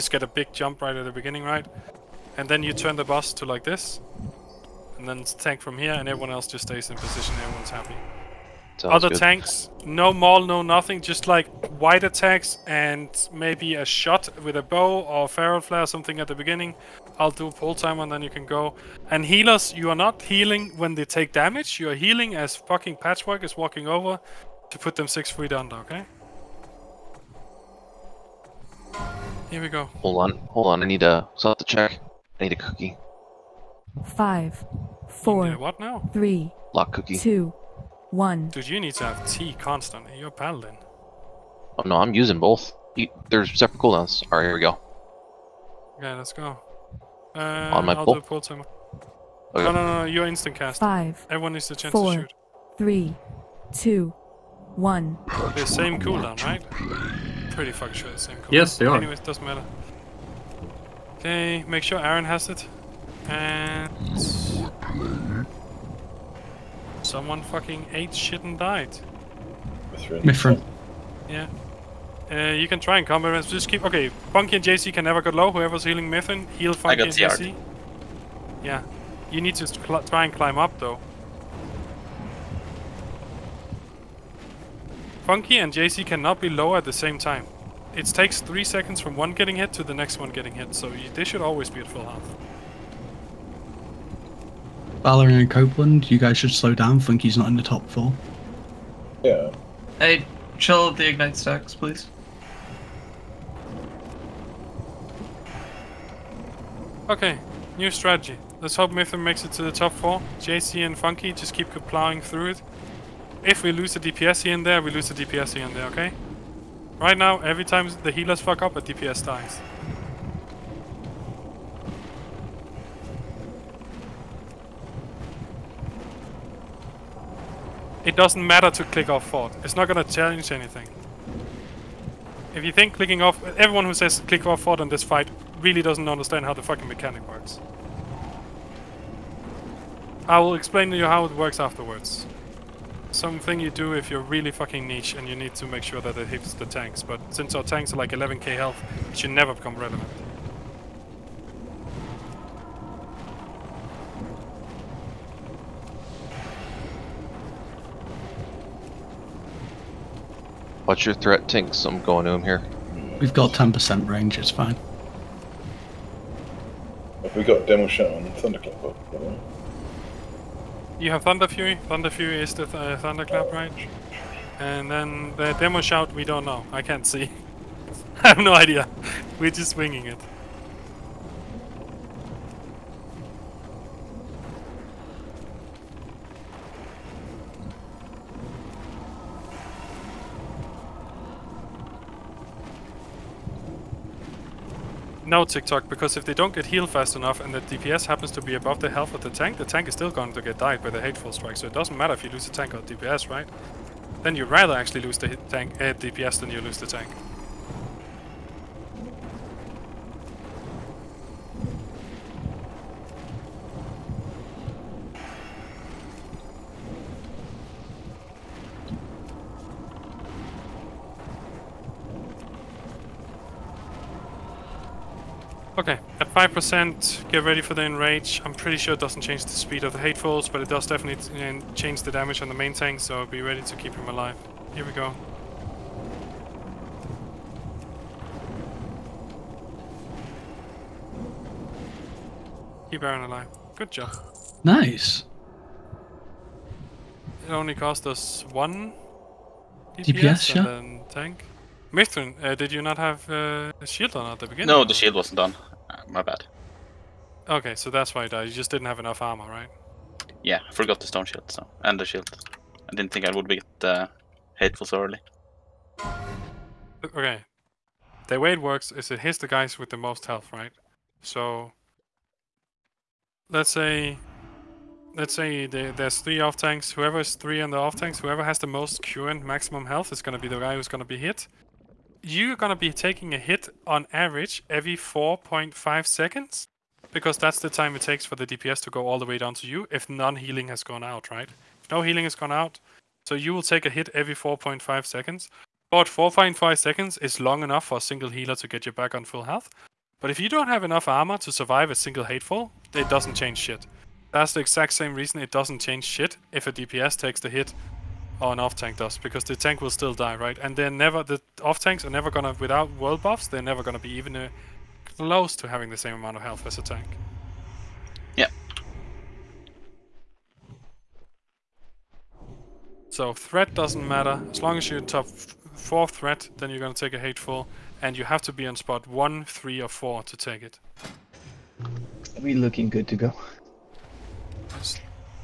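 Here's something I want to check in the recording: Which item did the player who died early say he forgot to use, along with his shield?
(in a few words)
stone shield.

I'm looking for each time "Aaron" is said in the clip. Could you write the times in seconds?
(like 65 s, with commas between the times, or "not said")
62 s, 243 s.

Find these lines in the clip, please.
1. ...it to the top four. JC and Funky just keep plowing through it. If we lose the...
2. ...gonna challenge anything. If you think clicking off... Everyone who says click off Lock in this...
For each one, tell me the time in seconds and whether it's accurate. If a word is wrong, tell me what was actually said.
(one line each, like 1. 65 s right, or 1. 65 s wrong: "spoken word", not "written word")
1. 109 s right
2. 129 s wrong: "Ford", not "Lock".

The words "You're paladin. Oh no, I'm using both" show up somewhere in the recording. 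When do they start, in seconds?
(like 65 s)
40 s.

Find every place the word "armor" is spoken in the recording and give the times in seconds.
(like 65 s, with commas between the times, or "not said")
259 s, 301 s.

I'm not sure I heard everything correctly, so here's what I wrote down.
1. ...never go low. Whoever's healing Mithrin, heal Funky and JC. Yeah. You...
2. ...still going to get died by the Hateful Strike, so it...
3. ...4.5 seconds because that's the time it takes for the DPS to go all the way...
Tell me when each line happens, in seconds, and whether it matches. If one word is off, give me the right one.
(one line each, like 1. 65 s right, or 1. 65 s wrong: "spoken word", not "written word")
1. 75 s right
2. 199 s right
3. 284 s right.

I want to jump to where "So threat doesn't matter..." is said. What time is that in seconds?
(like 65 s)
323 s.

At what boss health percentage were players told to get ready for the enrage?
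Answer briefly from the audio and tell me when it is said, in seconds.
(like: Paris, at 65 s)
5%, at 226 s.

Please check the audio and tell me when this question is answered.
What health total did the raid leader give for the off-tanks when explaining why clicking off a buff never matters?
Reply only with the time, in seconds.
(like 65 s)
148 s.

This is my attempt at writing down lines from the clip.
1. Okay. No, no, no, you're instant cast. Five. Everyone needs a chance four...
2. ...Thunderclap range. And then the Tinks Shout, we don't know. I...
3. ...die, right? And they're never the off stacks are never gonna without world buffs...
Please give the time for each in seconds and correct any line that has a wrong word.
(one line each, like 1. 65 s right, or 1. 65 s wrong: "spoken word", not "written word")
1. 49 s right
2. 172 s wrong: "Demo", not "Tinks"
3. 310 s wrong: "tanks", not "stacks".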